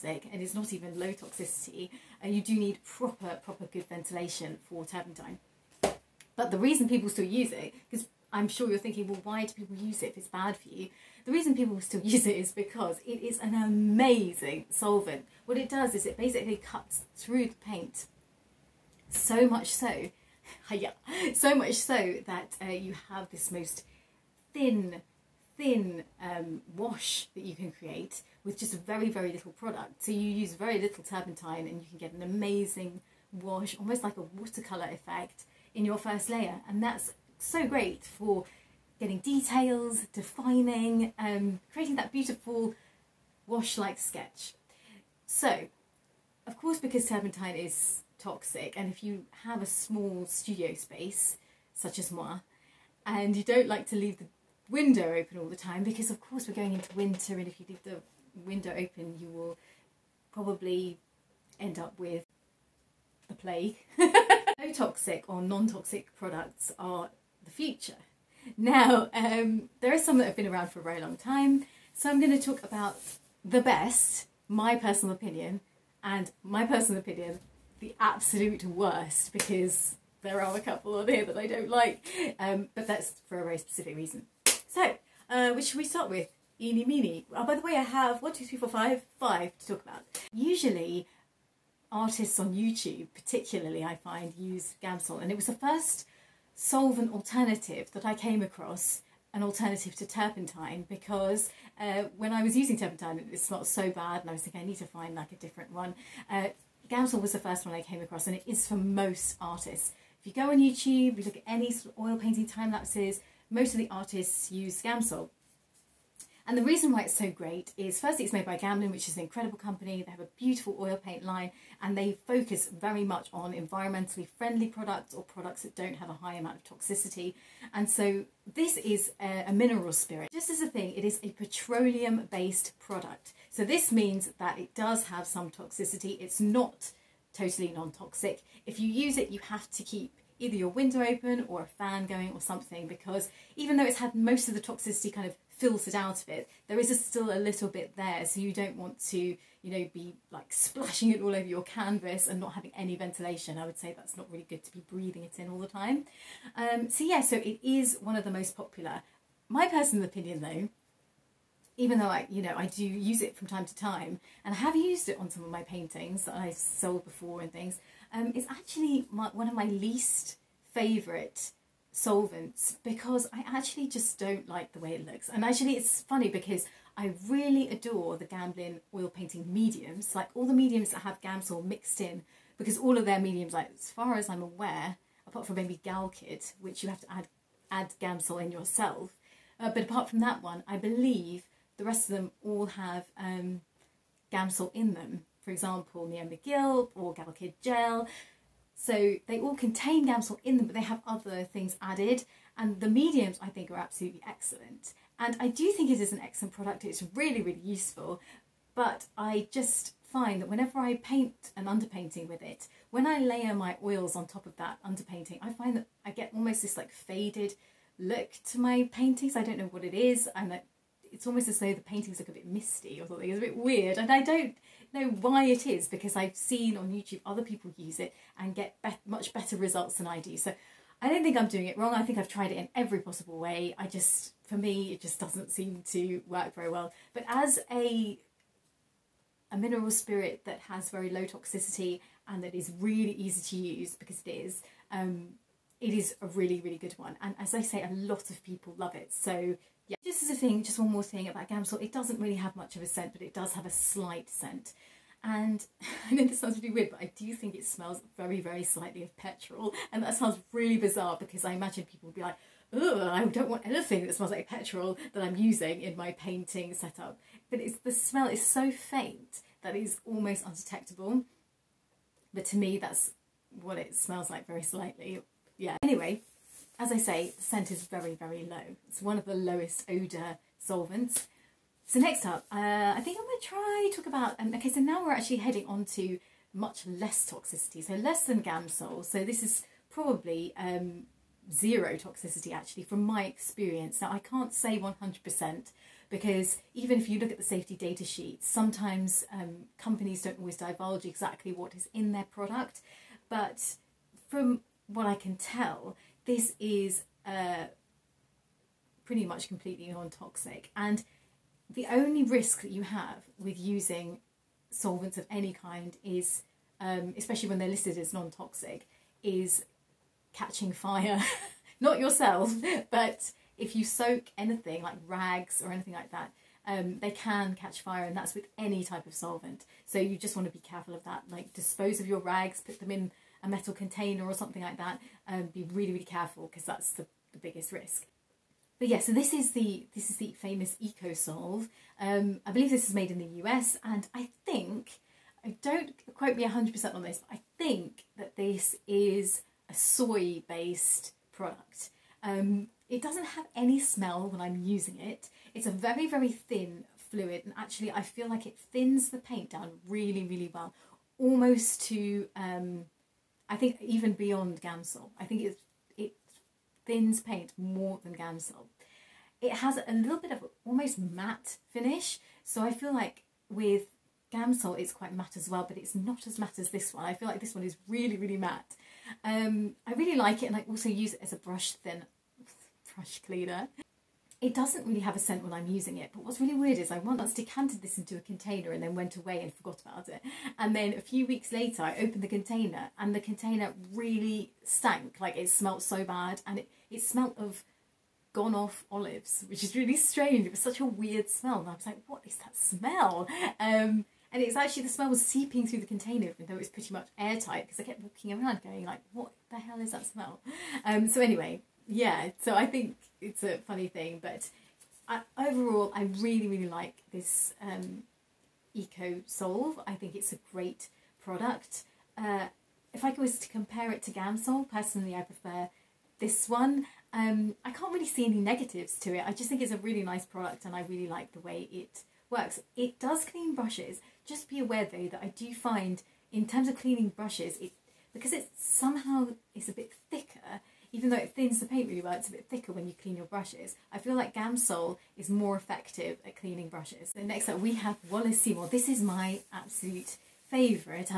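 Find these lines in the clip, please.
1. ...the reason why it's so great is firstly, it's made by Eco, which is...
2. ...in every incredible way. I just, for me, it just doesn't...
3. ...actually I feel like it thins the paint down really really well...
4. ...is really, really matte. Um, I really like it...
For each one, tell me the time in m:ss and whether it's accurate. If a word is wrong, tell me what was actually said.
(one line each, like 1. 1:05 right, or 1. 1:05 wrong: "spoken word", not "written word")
1. 1:56 wrong: "Gamblin", not "Eco"
2. 3:52 wrong: "possible", not "incredible"
3. 5:57 right
4. 6:17 right.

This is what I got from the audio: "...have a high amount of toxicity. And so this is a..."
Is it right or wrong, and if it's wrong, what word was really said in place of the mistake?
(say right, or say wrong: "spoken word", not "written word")
right.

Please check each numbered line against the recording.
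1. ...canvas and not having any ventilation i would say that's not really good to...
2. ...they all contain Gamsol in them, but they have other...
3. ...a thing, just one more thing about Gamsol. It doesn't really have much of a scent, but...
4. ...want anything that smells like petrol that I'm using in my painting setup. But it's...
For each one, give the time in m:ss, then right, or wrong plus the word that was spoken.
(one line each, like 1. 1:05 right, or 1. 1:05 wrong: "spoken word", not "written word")
1. 2:31 right
2. 3:19 right
3. 4:10 right
4. 4:23 right.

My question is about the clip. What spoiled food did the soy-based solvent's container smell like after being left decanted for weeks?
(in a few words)
Gone off olives.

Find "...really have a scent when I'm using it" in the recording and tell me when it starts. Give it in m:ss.
6:24.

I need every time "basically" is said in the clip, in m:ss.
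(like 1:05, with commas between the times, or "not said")
0:16.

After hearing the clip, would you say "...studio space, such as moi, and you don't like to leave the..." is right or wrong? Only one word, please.
right.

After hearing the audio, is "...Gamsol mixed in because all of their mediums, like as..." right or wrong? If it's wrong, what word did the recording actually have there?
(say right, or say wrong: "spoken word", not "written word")
right.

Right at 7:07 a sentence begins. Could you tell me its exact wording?
Um, I can't really see any negatives to it.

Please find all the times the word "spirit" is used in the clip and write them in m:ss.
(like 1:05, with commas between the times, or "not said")
2:09, 3:59.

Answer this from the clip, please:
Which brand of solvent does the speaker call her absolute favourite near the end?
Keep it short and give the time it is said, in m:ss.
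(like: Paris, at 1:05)
Wallace Seymour, at 7:28.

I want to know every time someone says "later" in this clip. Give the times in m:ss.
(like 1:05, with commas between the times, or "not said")
6:31.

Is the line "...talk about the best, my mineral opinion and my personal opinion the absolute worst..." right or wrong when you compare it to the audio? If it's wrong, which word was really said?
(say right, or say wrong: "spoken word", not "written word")
wrong: "personal", not "mineral".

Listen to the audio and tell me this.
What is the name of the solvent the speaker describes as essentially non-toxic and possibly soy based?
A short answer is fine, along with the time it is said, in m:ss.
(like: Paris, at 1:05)
EcoSolve, at 5:40.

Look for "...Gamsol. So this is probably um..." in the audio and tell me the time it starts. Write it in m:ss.
4:48.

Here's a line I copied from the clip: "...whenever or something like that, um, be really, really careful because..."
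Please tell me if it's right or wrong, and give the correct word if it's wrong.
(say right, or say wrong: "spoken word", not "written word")
wrong: "container", not "whenever".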